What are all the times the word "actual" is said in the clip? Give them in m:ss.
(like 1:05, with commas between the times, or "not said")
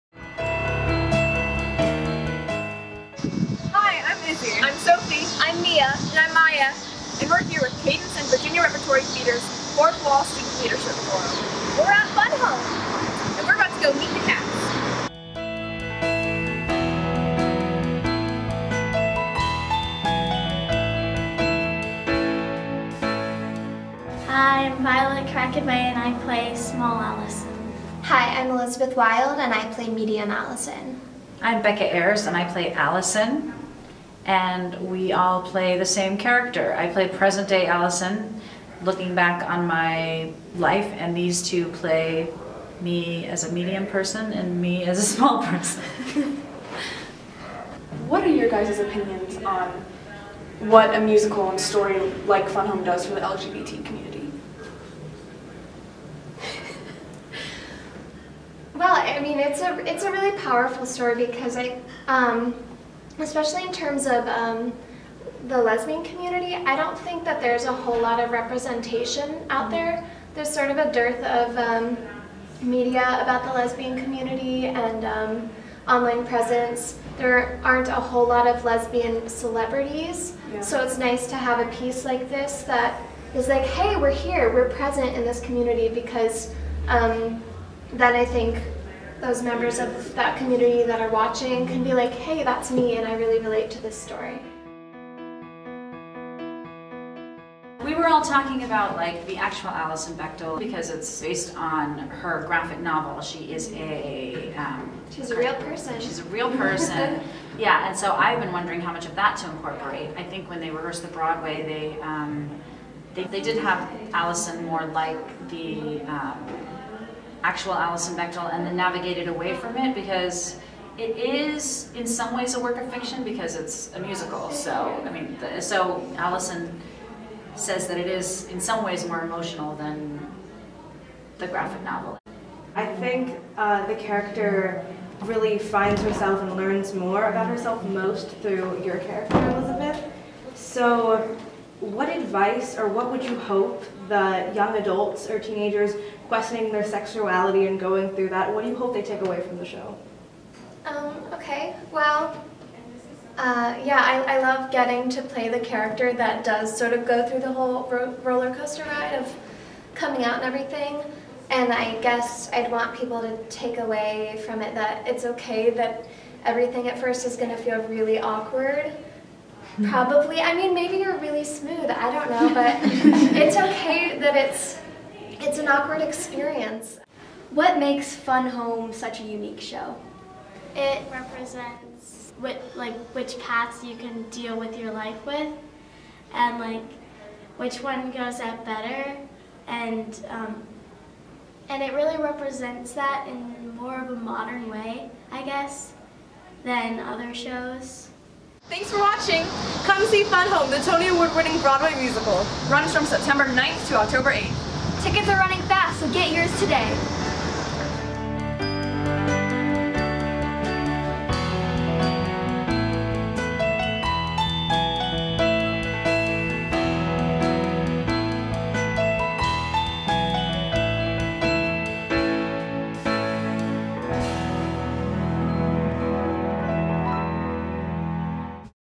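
1:39, 1:57.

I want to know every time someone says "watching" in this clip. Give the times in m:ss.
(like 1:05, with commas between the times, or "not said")
1:31, 3:18.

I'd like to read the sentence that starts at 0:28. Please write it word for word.
Hi, I'm Elizabeth Wild, and I play Medium Alison.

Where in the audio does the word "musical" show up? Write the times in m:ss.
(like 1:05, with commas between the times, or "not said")
0:50, 2:03, 3:22.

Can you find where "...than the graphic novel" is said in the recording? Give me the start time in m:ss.
2:09.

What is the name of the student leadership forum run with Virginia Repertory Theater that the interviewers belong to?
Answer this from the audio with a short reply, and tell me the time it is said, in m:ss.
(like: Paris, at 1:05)
Fourth Wall, at 0:09.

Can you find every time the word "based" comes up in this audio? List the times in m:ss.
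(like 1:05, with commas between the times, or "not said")
1:41.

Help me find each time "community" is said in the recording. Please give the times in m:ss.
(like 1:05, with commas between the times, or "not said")
0:53, 1:06, 1:14, 1:25, 1:30.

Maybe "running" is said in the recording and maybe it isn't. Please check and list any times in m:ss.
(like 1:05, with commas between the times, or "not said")
3:25.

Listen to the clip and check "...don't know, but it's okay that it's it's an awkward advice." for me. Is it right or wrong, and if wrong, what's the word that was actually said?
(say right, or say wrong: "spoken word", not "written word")
wrong: "experience", not "advice".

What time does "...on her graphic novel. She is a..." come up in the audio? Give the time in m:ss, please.
1:41.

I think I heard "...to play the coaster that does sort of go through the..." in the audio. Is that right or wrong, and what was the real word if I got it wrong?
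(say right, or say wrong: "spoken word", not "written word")
wrong: "character", not "coaster".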